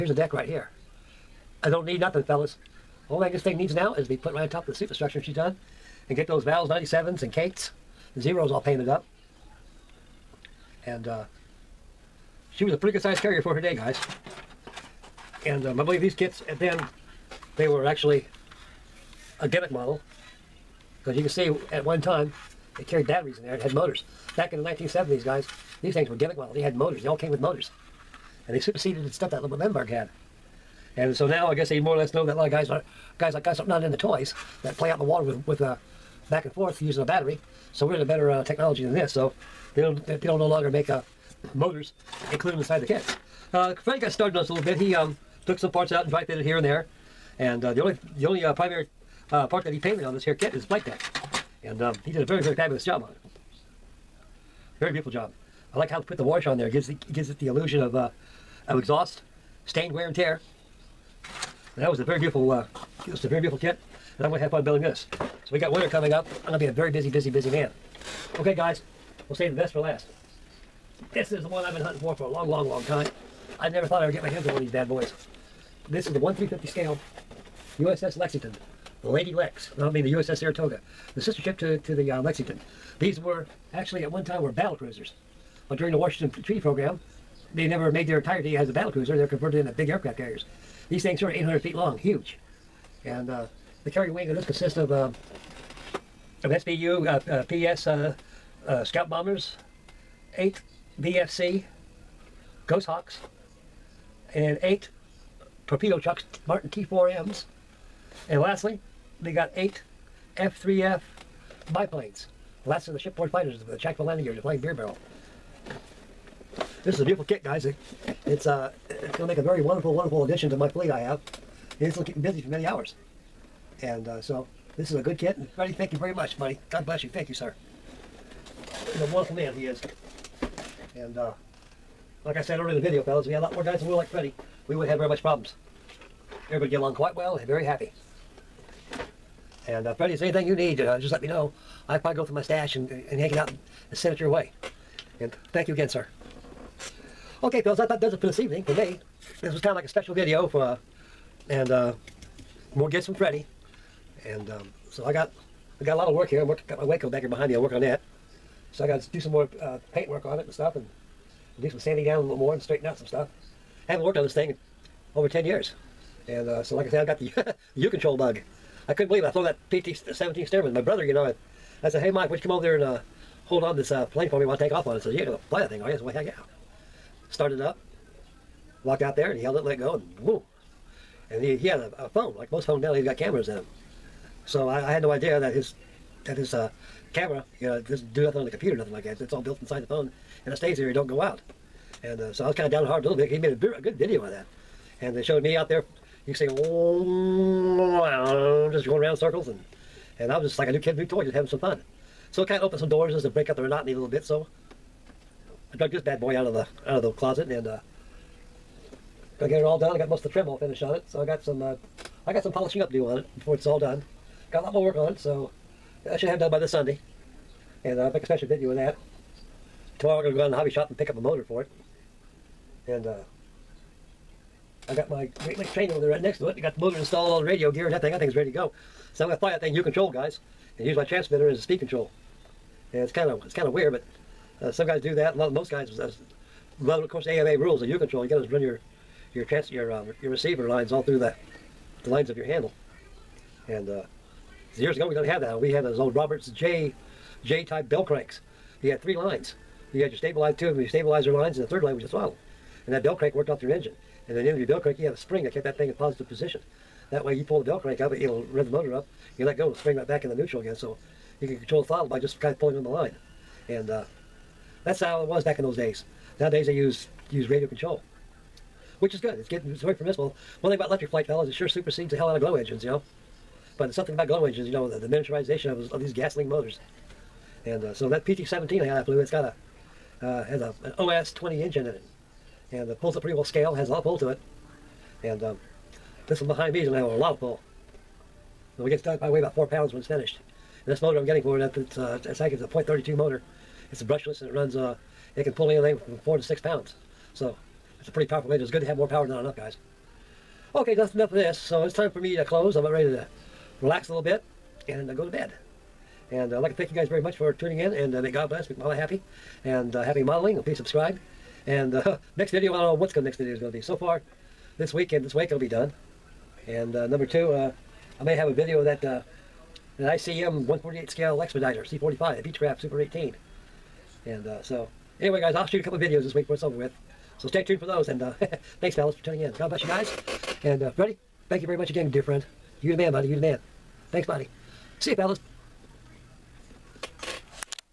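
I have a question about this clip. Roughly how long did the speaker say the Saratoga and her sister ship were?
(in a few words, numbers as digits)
800 feet.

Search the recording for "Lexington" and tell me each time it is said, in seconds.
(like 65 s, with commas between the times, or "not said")
78 s, 82 s.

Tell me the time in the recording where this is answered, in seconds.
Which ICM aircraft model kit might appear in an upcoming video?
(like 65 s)
322 s.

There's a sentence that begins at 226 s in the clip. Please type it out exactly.
I got the motor installed, all the radio gear and that thing.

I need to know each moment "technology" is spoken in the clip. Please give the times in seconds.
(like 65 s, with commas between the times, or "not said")
38 s.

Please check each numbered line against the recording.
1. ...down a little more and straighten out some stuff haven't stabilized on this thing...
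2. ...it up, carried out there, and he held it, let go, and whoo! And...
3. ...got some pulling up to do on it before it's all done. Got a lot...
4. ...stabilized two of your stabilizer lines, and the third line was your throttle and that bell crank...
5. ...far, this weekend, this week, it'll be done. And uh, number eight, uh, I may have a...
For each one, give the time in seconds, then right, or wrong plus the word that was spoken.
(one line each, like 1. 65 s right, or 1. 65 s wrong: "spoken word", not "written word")
1. 162 s wrong: "worked", not "stabilized"
2. 177 s wrong: "walked", not "carried"
3. 212 s wrong: "polishing", not "pulling"
4. 250 s right
5. 313 s wrong: "two", not "eight".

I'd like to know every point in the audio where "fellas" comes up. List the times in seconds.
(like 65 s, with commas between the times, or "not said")
2 s, 133 s, 147 s, 271 s, 328 s, 335 s.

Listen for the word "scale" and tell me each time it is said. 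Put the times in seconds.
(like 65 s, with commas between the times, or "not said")
76 s, 283 s, 321 s.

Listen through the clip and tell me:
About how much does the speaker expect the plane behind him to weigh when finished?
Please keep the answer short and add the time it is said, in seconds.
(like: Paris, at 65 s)
4 pounds, at 289 s.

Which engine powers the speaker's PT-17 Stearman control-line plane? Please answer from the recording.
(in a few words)
OS-20.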